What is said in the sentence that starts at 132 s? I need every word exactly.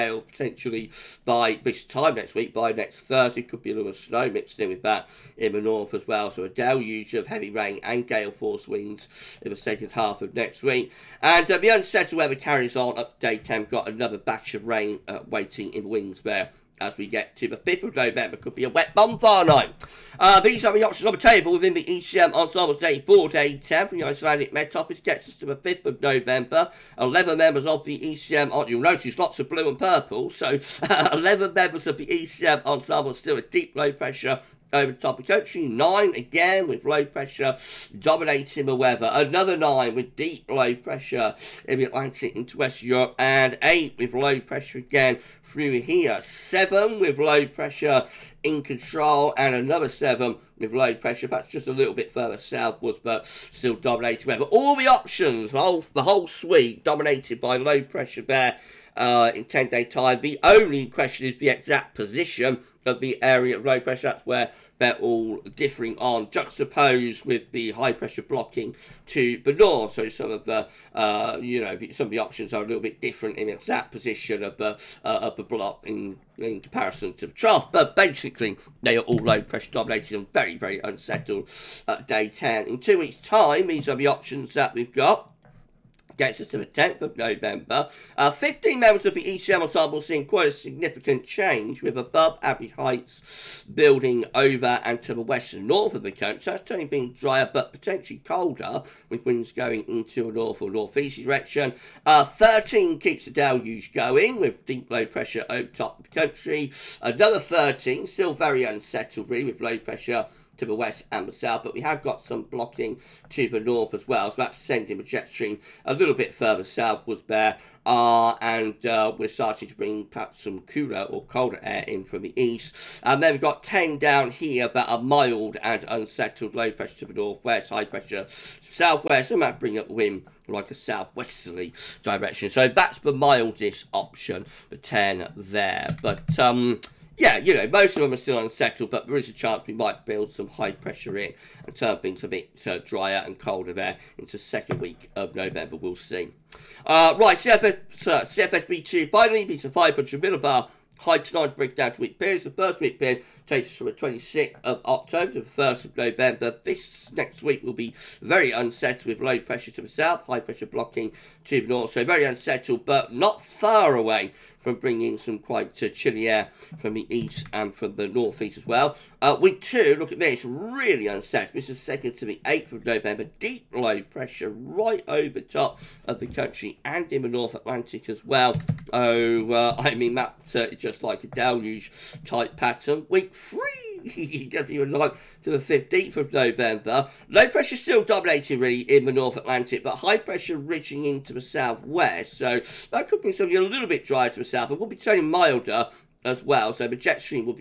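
So that's the mildest option, the 10 there.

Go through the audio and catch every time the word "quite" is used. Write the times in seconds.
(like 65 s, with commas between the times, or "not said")
90 s, 165 s.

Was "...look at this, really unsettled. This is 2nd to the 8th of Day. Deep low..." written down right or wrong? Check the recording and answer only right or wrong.
wrong.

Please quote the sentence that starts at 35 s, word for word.
Nine again with low pressure dominating the weather.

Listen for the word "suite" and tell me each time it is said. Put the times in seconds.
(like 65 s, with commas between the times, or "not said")
56 s.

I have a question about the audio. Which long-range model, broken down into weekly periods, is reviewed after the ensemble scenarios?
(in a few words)
CFSv2.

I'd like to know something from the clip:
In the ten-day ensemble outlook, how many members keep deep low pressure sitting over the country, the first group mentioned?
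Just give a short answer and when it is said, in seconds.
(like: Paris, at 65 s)
11, at 31 s.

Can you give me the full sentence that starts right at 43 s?
And eight with low pressure again through here.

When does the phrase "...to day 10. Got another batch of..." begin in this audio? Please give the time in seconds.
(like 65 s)
13 s.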